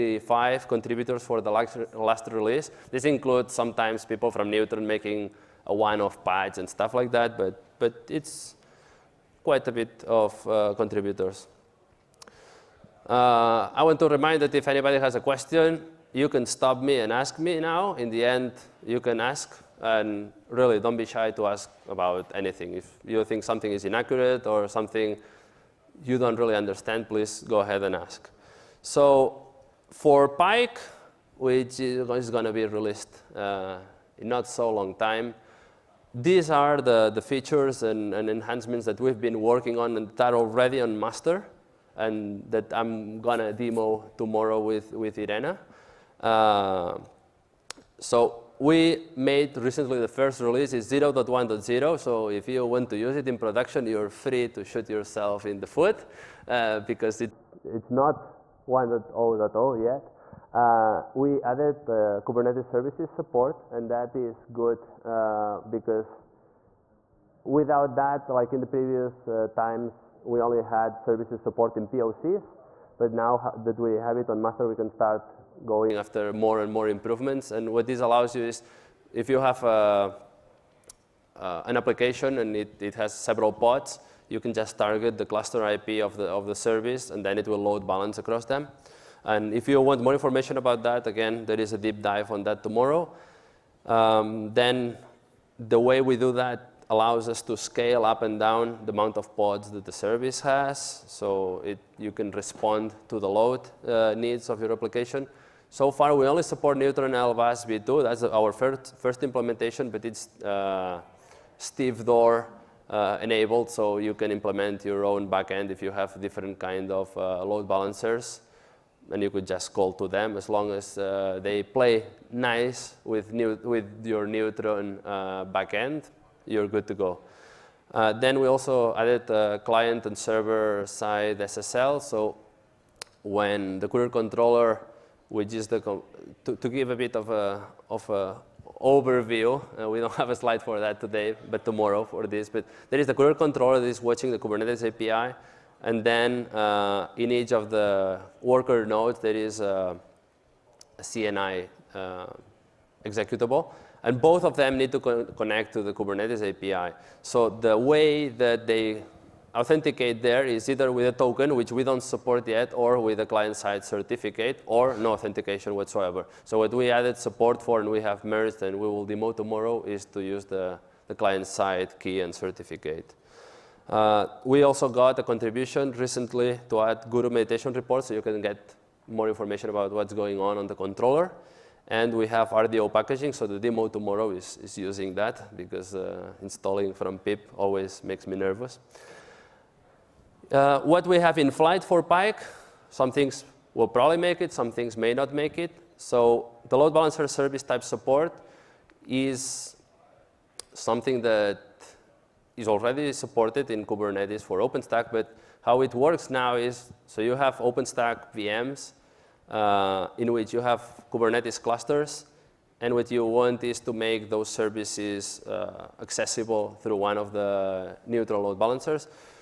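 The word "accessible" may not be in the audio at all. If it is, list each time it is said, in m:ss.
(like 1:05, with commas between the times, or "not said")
3:35.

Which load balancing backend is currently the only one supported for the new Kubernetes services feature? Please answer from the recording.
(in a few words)
Neutron LBaaS v2.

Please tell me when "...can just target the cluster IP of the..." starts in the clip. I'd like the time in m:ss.
1:24.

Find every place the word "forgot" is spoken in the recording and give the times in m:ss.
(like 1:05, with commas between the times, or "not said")
not said.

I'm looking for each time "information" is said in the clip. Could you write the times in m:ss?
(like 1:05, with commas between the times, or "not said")
1:30, 2:59.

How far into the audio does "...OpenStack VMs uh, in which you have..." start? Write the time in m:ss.
3:27.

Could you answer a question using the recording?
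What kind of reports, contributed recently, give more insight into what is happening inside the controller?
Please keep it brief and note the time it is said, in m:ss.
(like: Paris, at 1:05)
Guru meditation reports, at 2:57.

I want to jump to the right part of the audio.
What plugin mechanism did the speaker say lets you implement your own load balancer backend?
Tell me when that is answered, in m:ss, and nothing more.
1:51.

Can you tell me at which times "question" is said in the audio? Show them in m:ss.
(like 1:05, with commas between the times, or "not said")
0:15.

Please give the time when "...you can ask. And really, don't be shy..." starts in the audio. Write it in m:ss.
0:18.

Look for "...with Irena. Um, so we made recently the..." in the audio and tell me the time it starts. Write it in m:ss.
0:44.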